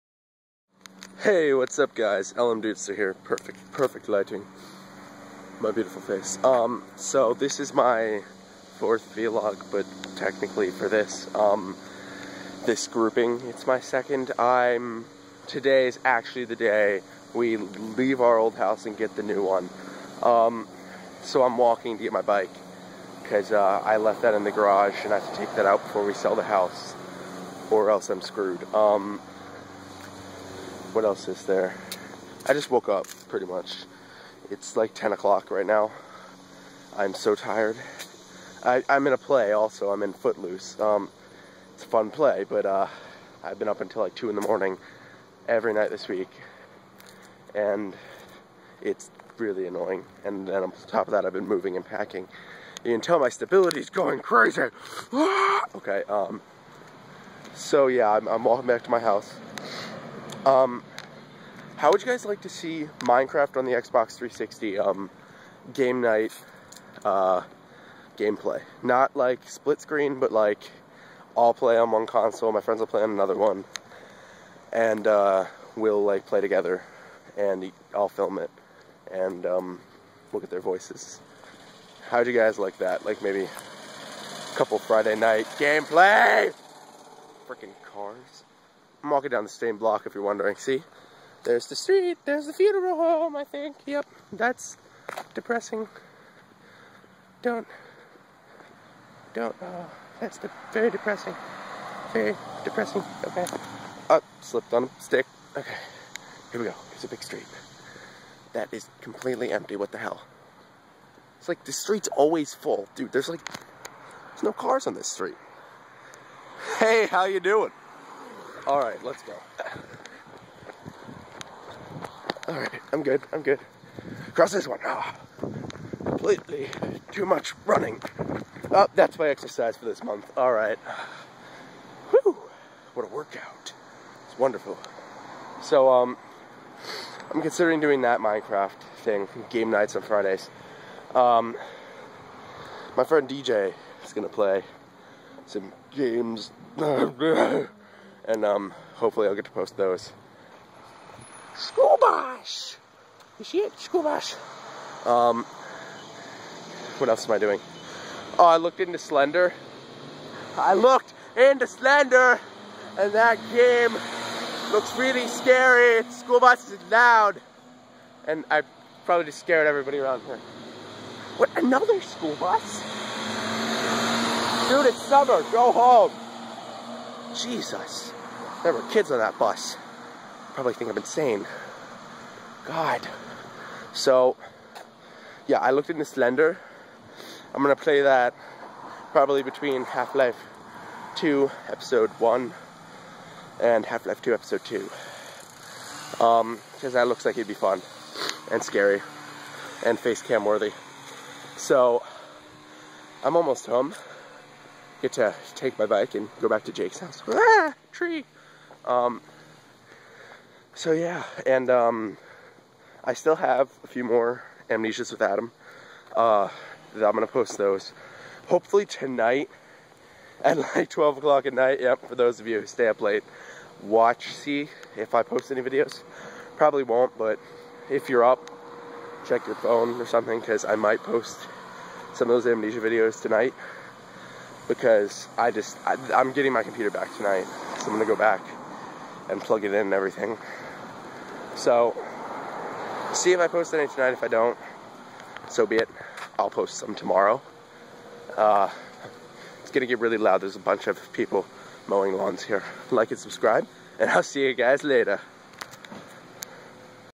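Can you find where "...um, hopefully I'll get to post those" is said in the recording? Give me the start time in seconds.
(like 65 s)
148 s.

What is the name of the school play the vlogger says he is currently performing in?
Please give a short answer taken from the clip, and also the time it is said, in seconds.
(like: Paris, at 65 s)
Footloose, at 40 s.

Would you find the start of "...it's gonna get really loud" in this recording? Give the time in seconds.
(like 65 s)
249 s.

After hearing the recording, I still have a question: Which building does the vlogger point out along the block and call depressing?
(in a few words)
The funeral home.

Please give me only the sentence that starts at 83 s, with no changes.
Like maybe a couple Friday night gameplay?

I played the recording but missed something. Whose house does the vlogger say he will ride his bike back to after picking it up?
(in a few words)
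Jake's.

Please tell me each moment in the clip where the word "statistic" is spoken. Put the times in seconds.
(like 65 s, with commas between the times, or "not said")
not said.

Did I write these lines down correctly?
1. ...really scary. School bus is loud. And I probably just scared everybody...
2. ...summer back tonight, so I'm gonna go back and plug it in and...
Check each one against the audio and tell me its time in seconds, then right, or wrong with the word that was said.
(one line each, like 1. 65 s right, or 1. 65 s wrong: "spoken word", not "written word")
1. 164 s right
2. 236 s wrong: "computer", not "summer".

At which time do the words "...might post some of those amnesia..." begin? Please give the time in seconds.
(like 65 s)
230 s.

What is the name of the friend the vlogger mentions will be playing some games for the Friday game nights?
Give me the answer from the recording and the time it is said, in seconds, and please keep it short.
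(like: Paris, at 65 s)
DJ, at 143 s.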